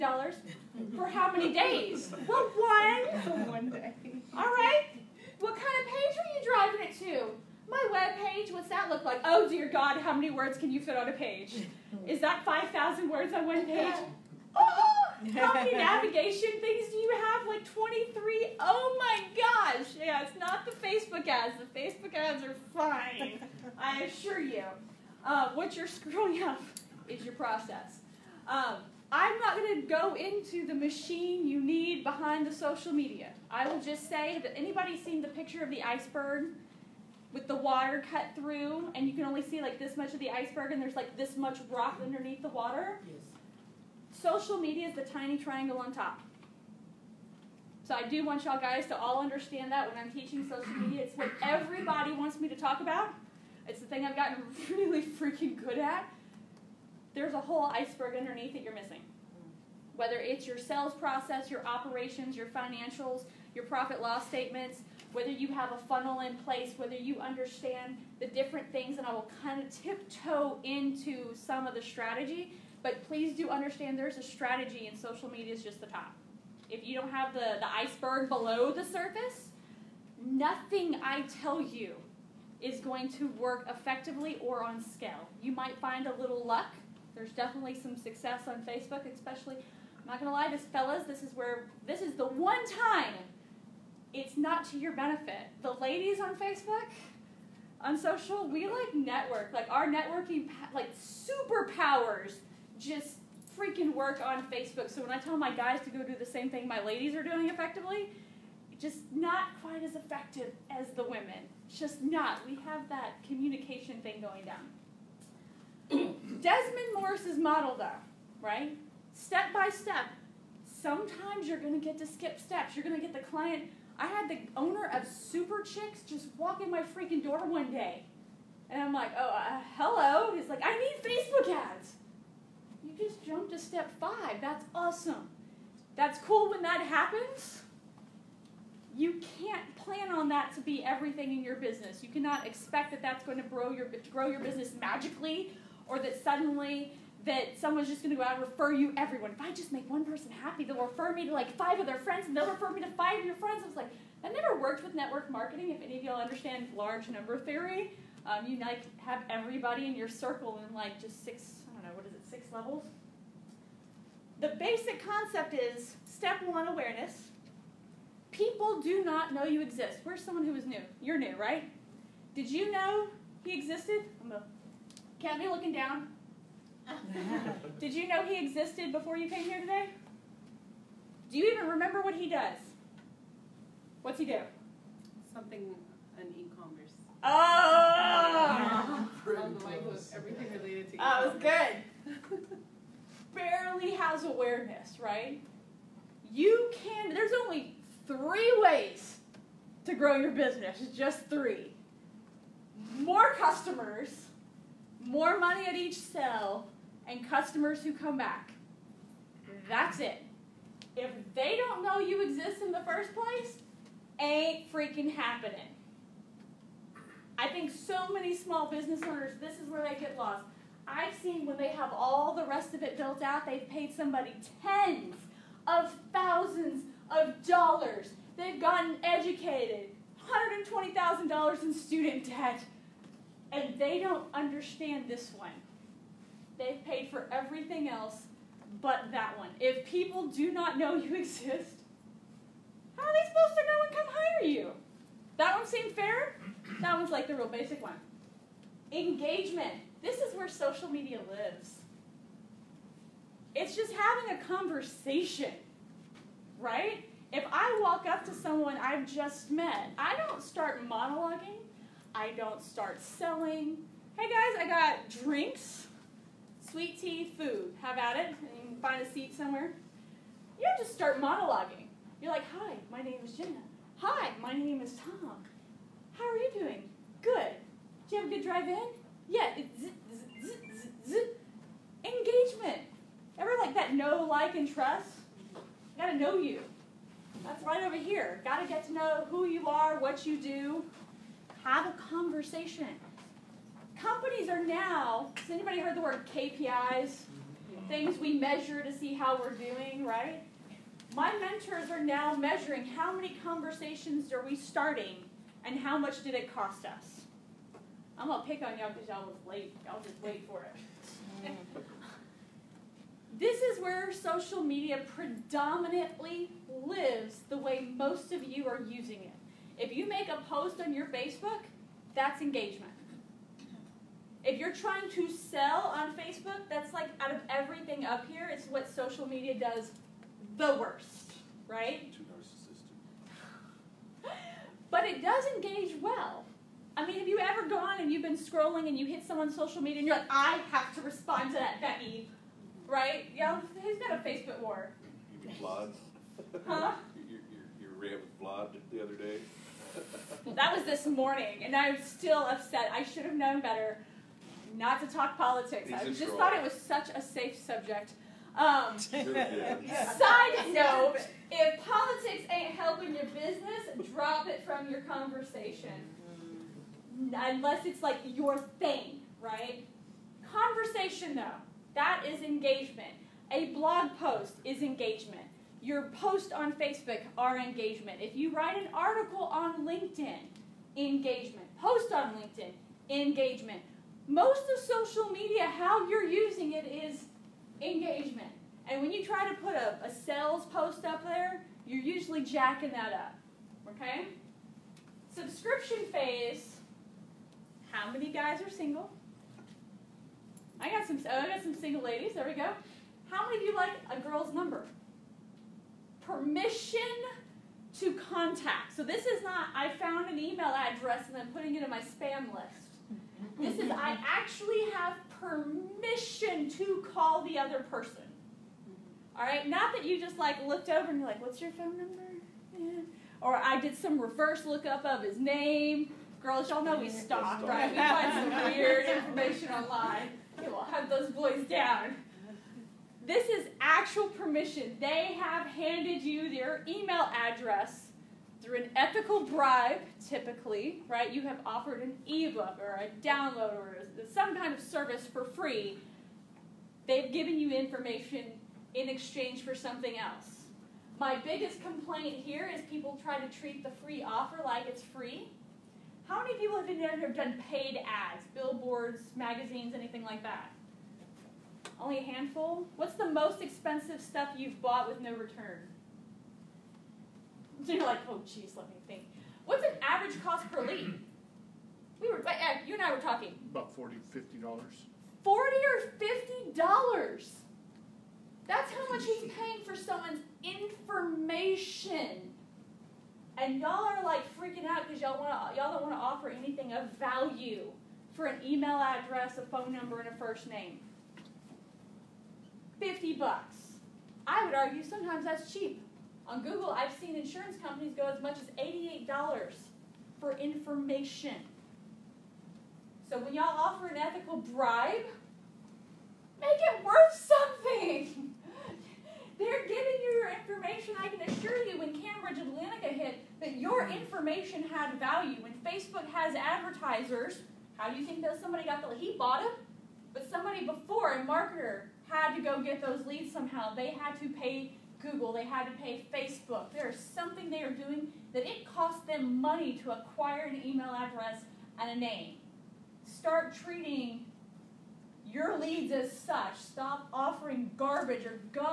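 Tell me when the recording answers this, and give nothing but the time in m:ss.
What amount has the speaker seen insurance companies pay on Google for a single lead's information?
8:18.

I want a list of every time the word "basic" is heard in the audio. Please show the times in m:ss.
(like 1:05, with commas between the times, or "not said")
2:44, 4:07.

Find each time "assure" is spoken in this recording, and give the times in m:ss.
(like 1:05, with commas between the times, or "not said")
0:24, 8:31.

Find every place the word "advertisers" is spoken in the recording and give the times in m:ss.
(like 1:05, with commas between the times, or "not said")
8:36.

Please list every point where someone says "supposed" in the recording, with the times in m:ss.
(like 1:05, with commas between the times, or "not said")
4:03.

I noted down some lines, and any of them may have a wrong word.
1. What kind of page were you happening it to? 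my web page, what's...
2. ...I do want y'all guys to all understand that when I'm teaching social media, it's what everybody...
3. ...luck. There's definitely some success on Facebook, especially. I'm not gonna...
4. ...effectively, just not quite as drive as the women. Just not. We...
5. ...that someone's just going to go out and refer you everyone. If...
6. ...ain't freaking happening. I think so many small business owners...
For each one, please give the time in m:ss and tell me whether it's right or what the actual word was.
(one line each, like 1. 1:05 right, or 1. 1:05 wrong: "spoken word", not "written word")
1. 0:05 wrong: "driving", not "happening"
2. 0:47 right
3. 1:26 right
4. 1:47 wrong: "effective", not "drive"
5. 2:27 right
6. 3:34 right.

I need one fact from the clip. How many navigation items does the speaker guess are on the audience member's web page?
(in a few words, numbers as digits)
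23.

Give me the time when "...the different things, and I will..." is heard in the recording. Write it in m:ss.
1:08.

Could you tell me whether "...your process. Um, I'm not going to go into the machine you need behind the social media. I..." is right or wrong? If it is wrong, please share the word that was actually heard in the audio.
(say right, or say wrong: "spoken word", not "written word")
right.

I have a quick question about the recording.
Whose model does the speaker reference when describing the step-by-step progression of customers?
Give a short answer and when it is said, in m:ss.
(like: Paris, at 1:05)
Desmond Morris, at 1:56.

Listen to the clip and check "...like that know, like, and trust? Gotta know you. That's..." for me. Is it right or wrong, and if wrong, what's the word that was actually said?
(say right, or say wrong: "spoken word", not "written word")
right.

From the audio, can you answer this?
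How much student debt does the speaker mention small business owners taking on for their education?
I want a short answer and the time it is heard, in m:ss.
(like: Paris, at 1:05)
$120,000, at 3:50.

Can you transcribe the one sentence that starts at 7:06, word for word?
Girls, y'all know we stalk, right?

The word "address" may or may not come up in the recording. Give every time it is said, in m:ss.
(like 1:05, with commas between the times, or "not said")
6:50, 7:17, 8:09, 8:51.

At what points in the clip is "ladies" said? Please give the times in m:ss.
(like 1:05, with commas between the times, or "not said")
1:35, 1:46, 6:42.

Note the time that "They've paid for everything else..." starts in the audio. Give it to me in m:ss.
3:56.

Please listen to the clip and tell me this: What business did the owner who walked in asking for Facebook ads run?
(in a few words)
Super Chix.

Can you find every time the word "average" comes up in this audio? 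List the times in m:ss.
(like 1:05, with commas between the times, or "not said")
7:50.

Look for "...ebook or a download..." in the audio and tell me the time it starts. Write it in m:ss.
7:22.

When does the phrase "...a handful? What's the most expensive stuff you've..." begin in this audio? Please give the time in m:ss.
7:42.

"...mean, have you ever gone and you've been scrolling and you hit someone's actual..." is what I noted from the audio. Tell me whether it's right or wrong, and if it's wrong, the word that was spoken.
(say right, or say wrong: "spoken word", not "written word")
wrong: "social", not "actual".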